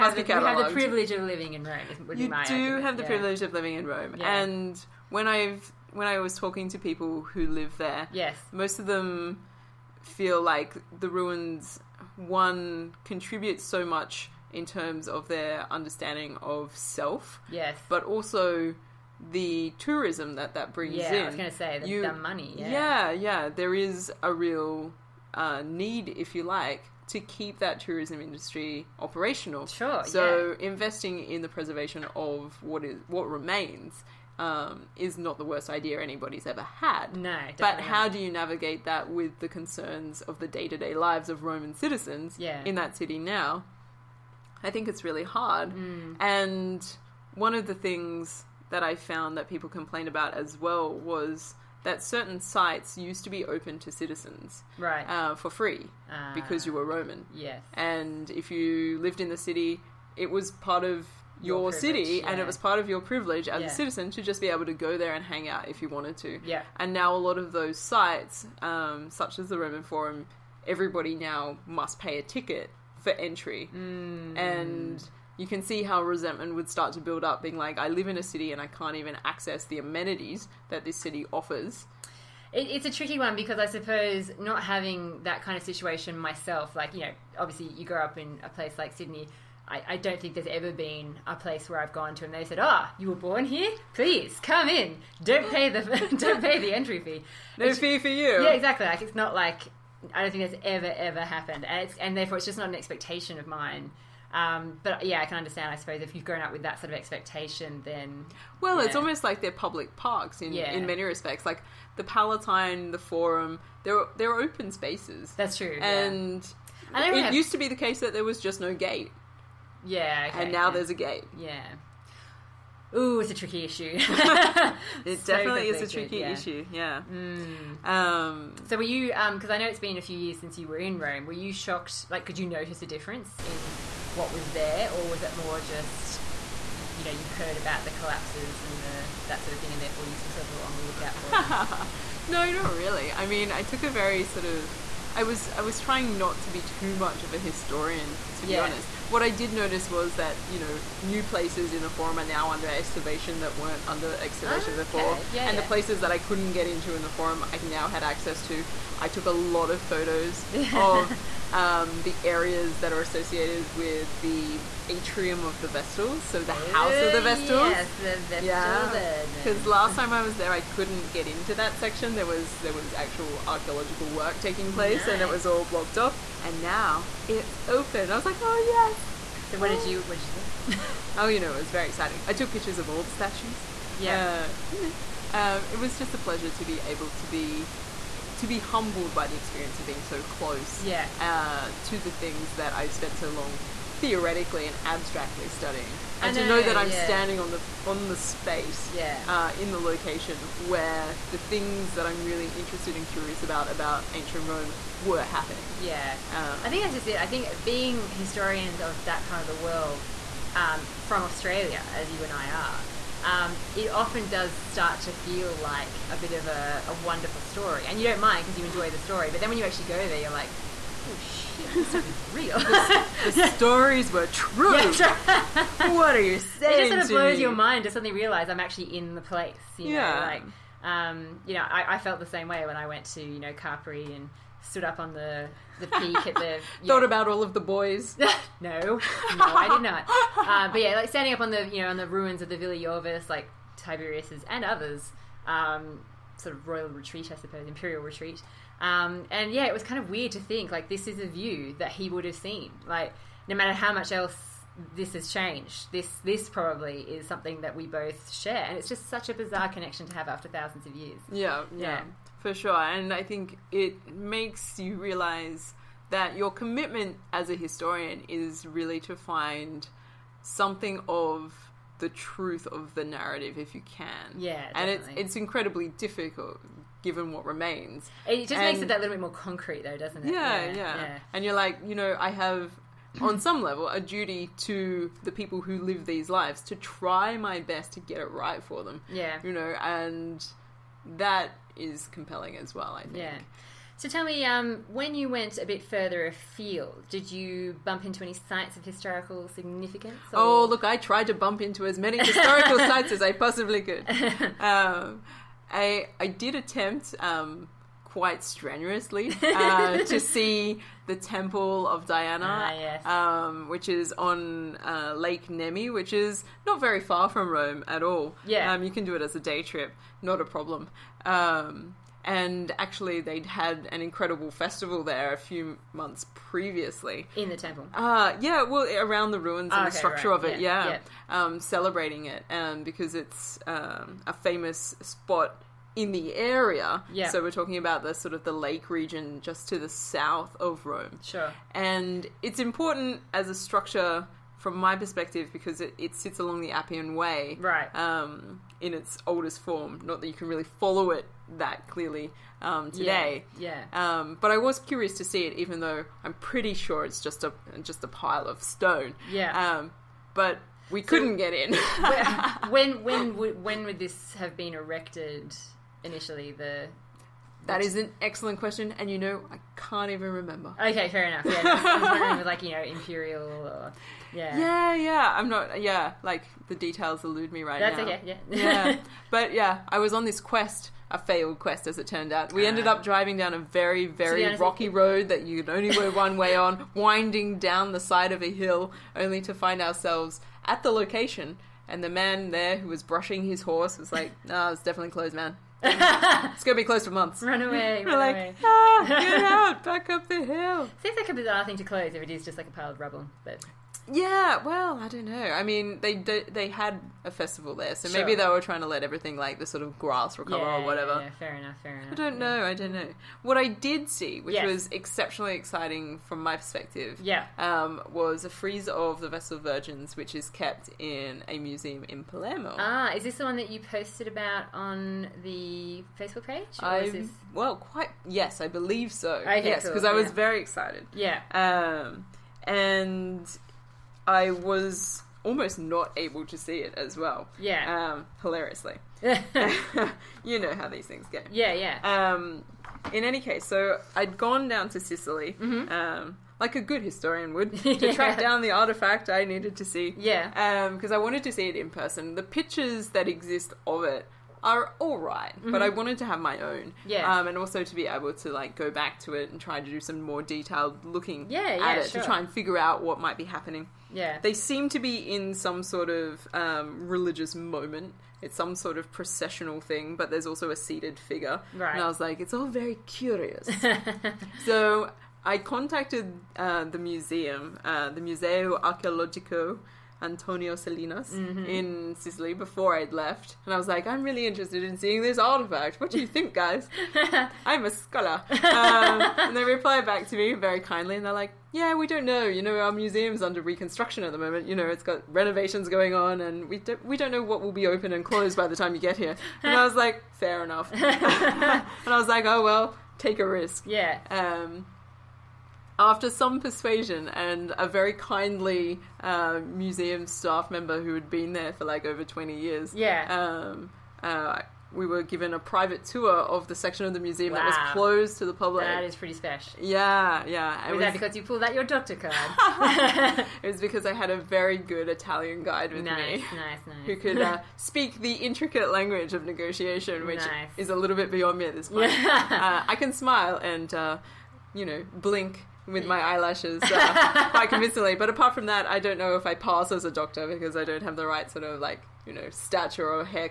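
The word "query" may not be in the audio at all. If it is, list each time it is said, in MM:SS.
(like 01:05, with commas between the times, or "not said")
not said.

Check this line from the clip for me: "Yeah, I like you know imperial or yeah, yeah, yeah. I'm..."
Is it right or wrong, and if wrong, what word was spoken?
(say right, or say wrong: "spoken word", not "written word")
right.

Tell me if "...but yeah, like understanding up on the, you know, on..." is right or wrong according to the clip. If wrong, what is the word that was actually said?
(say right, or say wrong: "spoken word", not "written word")
wrong: "standing", not "understanding".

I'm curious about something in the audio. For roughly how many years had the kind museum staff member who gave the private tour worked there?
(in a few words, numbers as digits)
over 20.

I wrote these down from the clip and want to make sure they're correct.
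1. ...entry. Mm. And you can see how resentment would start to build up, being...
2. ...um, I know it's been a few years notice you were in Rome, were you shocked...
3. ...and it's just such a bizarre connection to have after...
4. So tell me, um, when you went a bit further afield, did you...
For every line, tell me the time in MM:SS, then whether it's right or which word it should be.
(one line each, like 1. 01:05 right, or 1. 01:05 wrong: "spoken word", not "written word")
1. 01:13 right
2. 02:09 wrong: "since", not "notice"
3. 04:18 right
4. 04:53 right.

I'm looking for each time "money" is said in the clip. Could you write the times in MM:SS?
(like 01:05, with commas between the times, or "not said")
00:22.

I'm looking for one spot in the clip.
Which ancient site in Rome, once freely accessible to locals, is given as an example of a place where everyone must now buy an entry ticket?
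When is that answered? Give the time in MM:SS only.
01:09.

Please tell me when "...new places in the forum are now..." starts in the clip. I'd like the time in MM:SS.
02:31.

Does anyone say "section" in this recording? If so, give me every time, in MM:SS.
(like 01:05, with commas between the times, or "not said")
02:51, 08:36.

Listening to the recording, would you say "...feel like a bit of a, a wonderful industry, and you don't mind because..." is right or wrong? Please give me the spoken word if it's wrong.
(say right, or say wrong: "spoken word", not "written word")
wrong: "story", not "industry".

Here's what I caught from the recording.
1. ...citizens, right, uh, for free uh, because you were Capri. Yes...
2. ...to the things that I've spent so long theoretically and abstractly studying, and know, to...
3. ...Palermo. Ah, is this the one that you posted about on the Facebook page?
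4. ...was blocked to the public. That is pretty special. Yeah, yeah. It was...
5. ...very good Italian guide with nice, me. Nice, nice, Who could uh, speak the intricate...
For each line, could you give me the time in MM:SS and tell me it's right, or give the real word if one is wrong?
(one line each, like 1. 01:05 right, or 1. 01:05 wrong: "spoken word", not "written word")
1. 00:53 wrong: "Roman", not "Capri"
2. 03:11 right
3. 07:02 right
4. 08:37 wrong: "closed", not "blocked"
5. 08:44 right.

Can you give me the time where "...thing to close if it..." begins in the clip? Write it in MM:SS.
06:41.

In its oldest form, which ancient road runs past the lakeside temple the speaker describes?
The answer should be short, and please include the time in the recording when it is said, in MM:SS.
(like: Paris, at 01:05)
Appian Way, at 05:46.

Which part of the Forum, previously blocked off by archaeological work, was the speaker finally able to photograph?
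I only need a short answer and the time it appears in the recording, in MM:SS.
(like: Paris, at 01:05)
House of the Vestals, at 02:46.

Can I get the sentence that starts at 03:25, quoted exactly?
Yeah, um, I think that's just it.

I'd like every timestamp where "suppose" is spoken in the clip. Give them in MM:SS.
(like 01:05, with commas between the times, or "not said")
01:23, 01:45, 04:07.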